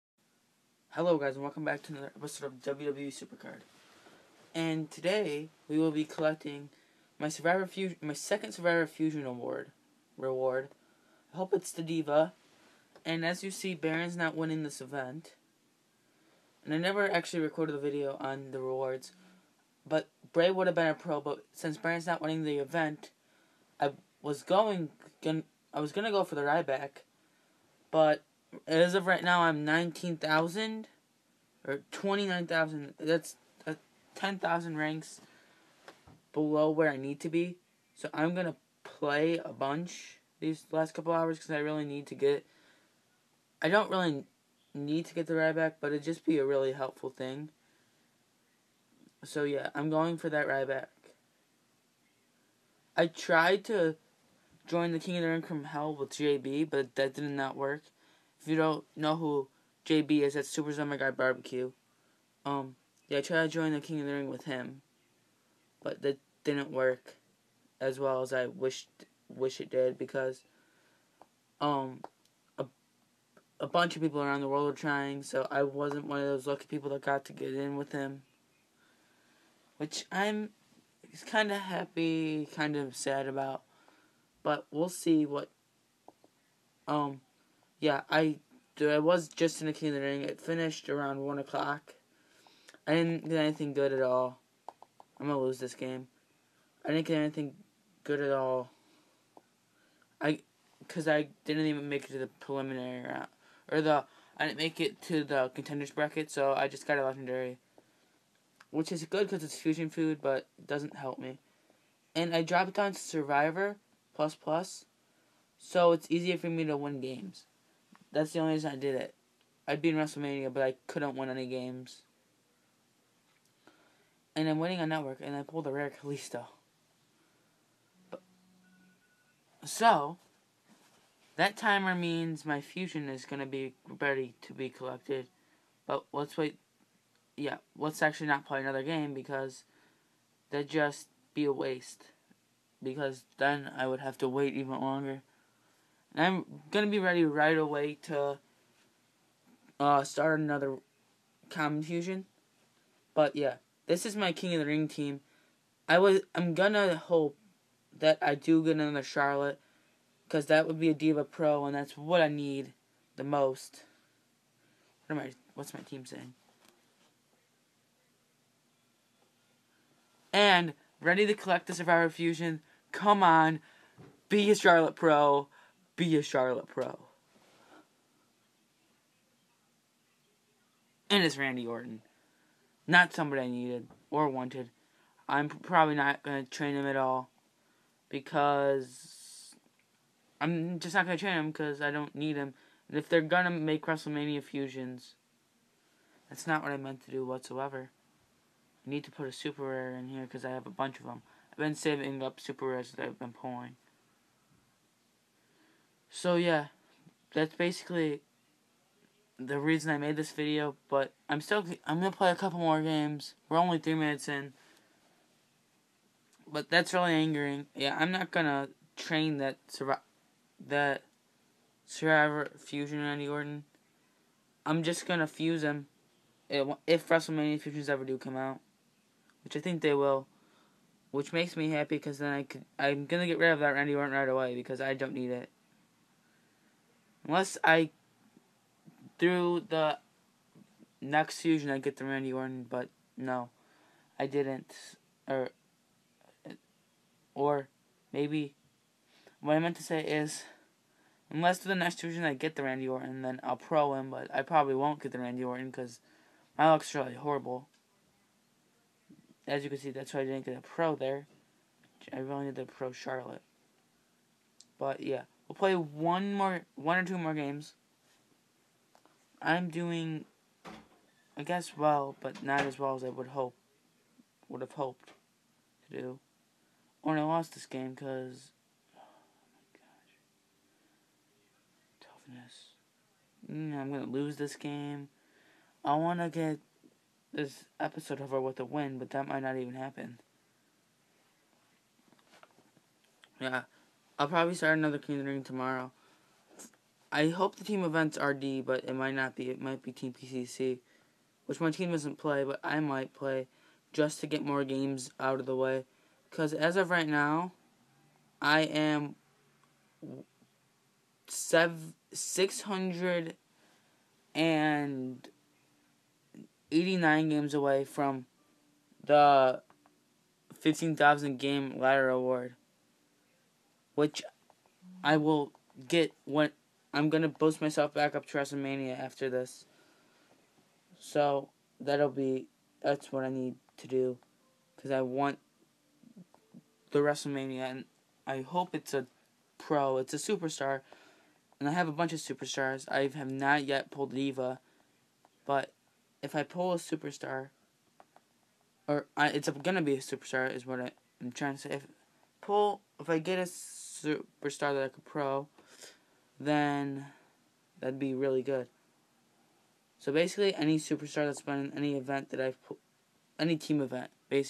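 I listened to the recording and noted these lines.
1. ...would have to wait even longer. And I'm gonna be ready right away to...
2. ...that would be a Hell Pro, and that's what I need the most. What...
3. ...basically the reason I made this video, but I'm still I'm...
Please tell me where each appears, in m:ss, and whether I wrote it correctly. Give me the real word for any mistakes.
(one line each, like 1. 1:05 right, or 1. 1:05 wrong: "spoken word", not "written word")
1. 2:23 right
2. 2:40 wrong: "Diva", not "Hell"
3. 3:27 right.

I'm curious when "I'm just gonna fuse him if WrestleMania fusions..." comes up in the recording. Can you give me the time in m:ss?
3:44.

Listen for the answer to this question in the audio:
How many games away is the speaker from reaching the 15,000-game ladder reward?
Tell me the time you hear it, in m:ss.
5:12.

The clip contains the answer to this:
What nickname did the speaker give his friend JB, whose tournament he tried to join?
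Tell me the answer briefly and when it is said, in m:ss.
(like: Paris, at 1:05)
Super Summer Guy Barbecue, at 1:00.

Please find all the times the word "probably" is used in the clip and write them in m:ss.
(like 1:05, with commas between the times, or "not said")
3:05, 4:14, 4:54.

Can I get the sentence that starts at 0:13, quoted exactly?
And as you see Baron's not winning this event.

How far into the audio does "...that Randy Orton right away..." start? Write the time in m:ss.
3:53.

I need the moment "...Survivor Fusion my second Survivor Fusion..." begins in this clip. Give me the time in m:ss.
0:07.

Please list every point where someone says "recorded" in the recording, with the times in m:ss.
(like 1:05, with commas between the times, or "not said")
0:17.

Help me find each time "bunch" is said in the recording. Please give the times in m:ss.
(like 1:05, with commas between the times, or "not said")
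0:39, 1:13, 3:20, 5:41.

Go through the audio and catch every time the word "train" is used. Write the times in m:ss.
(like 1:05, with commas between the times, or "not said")
3:06, 3:11, 3:38.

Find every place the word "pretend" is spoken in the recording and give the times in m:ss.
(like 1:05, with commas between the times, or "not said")
not said.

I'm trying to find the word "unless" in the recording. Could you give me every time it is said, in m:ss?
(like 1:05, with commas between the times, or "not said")
3:57, 4:11.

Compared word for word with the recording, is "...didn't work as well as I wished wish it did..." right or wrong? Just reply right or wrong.
right.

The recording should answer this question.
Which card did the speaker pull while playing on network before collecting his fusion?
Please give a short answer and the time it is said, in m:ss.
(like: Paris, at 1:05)
rare Kalisto, at 2:05.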